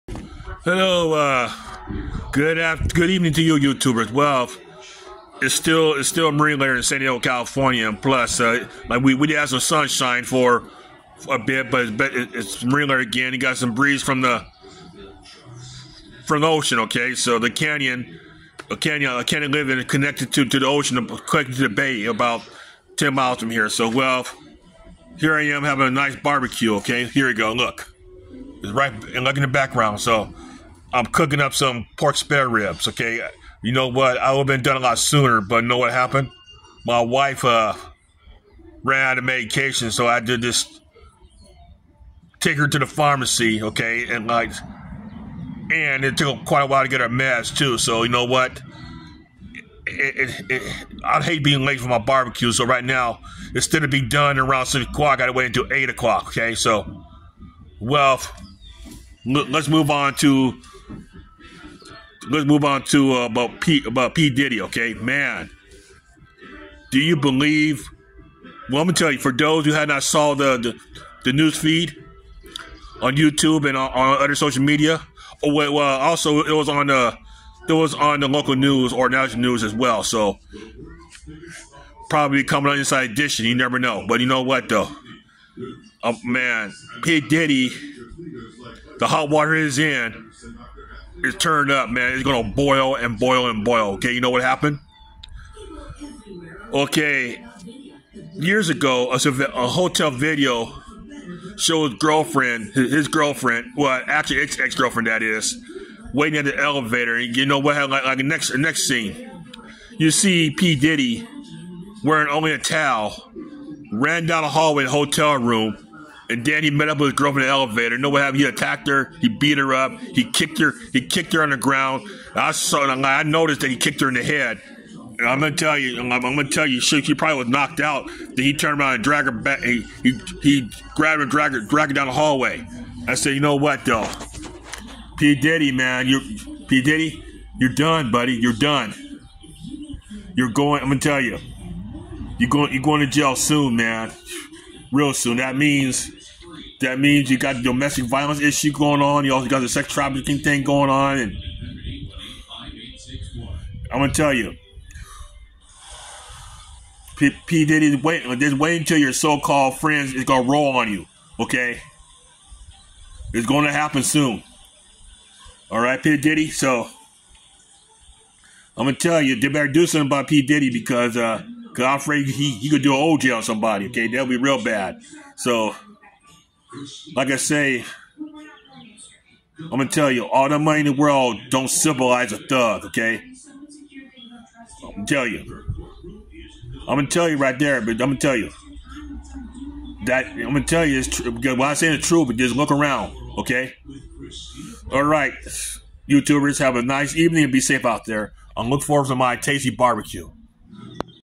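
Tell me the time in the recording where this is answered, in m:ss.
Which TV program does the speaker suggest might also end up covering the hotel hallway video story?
1:22.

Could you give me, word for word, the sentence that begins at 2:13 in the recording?
I said, you know what though, P Diddy man, you P Diddy, you're done, buddy.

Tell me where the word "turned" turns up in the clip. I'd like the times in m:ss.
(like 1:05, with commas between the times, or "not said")
1:31, 2:08.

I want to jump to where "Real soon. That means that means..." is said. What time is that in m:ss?
2:24.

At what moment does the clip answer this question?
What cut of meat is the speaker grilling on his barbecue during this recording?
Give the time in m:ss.
0:31.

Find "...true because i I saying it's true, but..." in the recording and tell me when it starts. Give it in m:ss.
3:11.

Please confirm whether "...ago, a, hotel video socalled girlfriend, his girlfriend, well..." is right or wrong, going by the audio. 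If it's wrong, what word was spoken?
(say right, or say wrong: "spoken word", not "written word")
wrong: "showed", not "socalled".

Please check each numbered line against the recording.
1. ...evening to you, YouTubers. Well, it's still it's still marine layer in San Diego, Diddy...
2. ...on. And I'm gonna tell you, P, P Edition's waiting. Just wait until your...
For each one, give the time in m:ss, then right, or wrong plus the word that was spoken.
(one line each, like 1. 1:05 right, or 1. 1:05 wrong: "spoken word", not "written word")
1. 0:03 wrong: "California", not "Diddy"
2. 2:30 wrong: "Diddy", not "Edition".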